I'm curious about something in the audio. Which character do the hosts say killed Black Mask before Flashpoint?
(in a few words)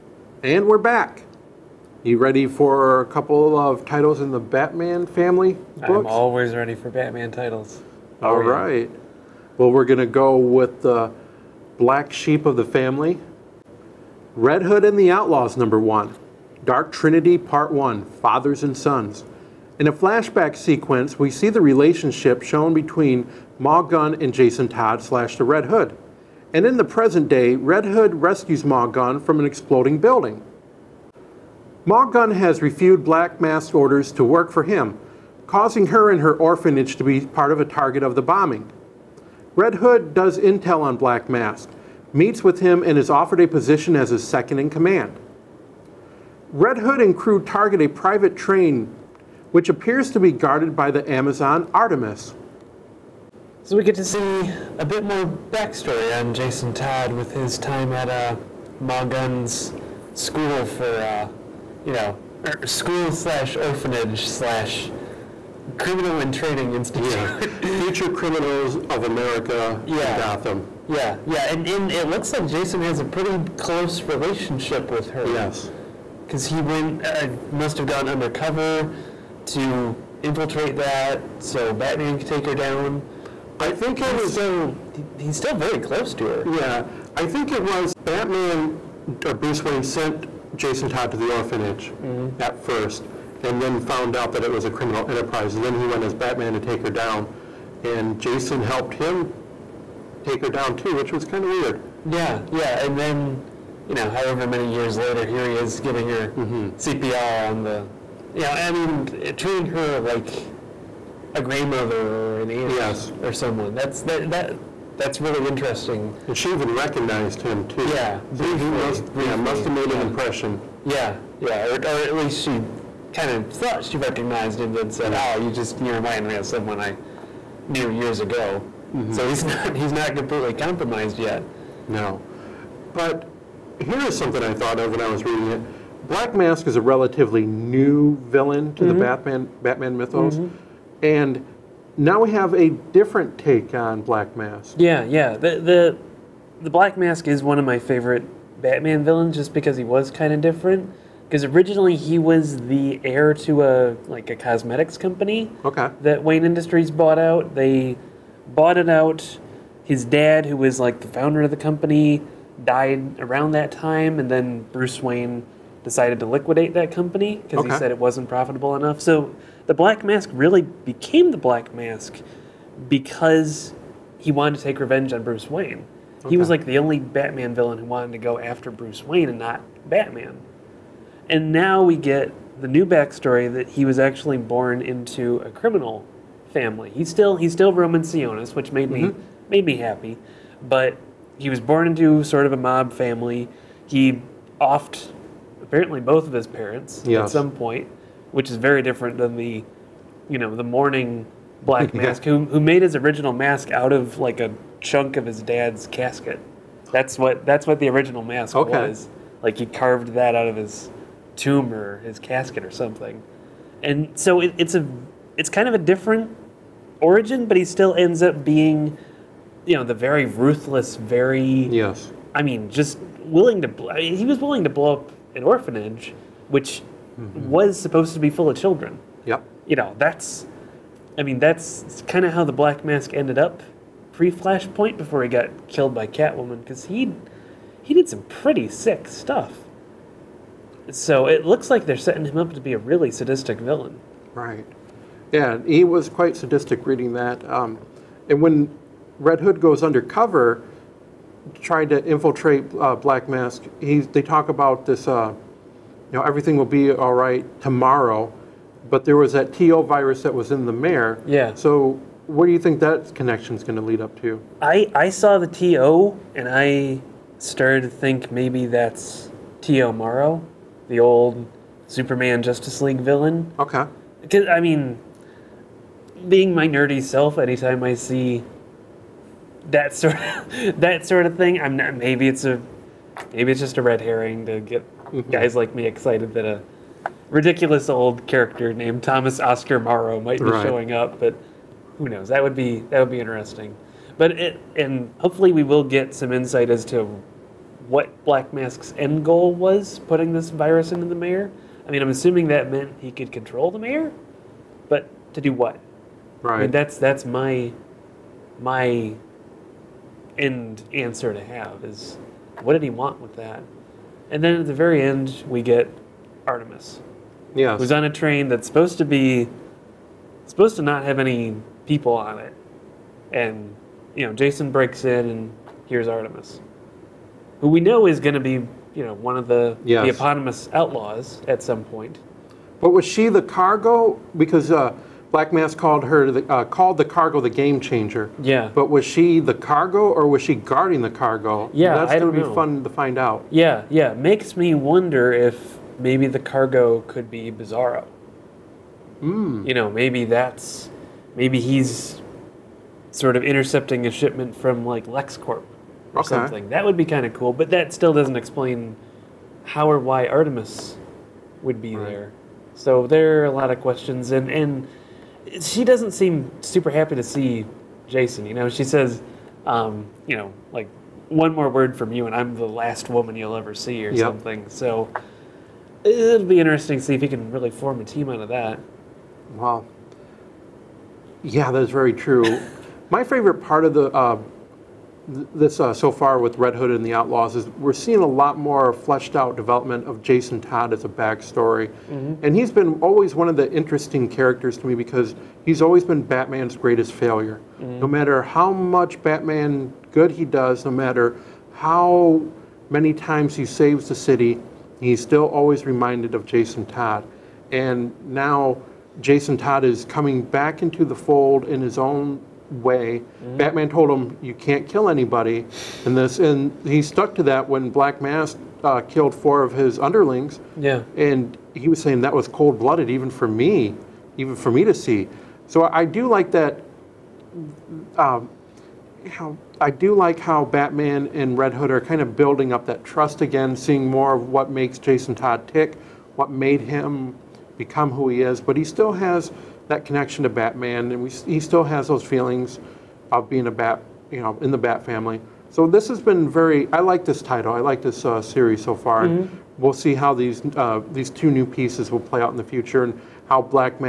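Catwoman.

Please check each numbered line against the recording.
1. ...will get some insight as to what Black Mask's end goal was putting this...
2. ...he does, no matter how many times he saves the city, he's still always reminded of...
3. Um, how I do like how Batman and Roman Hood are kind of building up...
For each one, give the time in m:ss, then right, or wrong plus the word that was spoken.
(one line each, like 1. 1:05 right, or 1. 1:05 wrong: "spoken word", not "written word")
1. 4:55 right
2. 6:40 right
3. 7:08 wrong: "Red", not "Roman".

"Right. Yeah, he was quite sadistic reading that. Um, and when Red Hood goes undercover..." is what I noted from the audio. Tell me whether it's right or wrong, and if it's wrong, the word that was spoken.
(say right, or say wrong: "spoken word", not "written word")
right.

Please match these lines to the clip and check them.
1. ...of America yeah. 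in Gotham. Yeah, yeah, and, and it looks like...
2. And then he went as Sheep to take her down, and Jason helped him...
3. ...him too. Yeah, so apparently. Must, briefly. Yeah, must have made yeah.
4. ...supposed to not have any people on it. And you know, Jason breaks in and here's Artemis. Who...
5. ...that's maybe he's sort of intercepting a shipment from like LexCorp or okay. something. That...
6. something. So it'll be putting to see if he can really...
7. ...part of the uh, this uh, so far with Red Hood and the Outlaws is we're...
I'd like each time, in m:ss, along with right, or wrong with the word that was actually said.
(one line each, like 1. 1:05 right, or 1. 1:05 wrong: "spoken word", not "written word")
1. 1:08 right
2. 1:35 wrong: "Batman", not "Sheep"
3. 1:57 wrong: "briefly", not "apparently"
4. 5:20 right
5. 5:50 right
6. 6:14 wrong: "interesting", not "putting"
7. 6:23 right.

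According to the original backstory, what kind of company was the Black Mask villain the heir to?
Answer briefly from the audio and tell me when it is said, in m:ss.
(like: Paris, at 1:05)
a cosmetics company, at 2:34.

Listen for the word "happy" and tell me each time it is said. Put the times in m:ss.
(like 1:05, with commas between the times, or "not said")
3:09, 6:06.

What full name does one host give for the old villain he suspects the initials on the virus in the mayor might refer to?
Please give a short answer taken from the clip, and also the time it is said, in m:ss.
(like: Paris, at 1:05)
Thomas Oscar Morrow, at 4:49.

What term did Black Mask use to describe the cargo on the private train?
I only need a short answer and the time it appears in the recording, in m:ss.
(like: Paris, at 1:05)
the game changer, at 5:37.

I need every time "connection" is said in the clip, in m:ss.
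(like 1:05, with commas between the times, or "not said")
4:23, 7:20.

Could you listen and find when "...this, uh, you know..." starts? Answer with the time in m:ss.
4:14.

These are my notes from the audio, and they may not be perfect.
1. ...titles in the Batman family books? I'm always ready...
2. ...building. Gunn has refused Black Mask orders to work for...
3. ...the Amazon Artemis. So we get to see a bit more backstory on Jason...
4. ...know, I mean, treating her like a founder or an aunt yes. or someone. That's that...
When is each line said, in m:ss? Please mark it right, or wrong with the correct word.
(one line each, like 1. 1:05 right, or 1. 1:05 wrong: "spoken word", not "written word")
1. 0:03 right
2. 0:29 right
3. 0:50 right
4. 1:48 wrong: "grandmother", not "founder".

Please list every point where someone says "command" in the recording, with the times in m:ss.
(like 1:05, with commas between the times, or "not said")
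0:44.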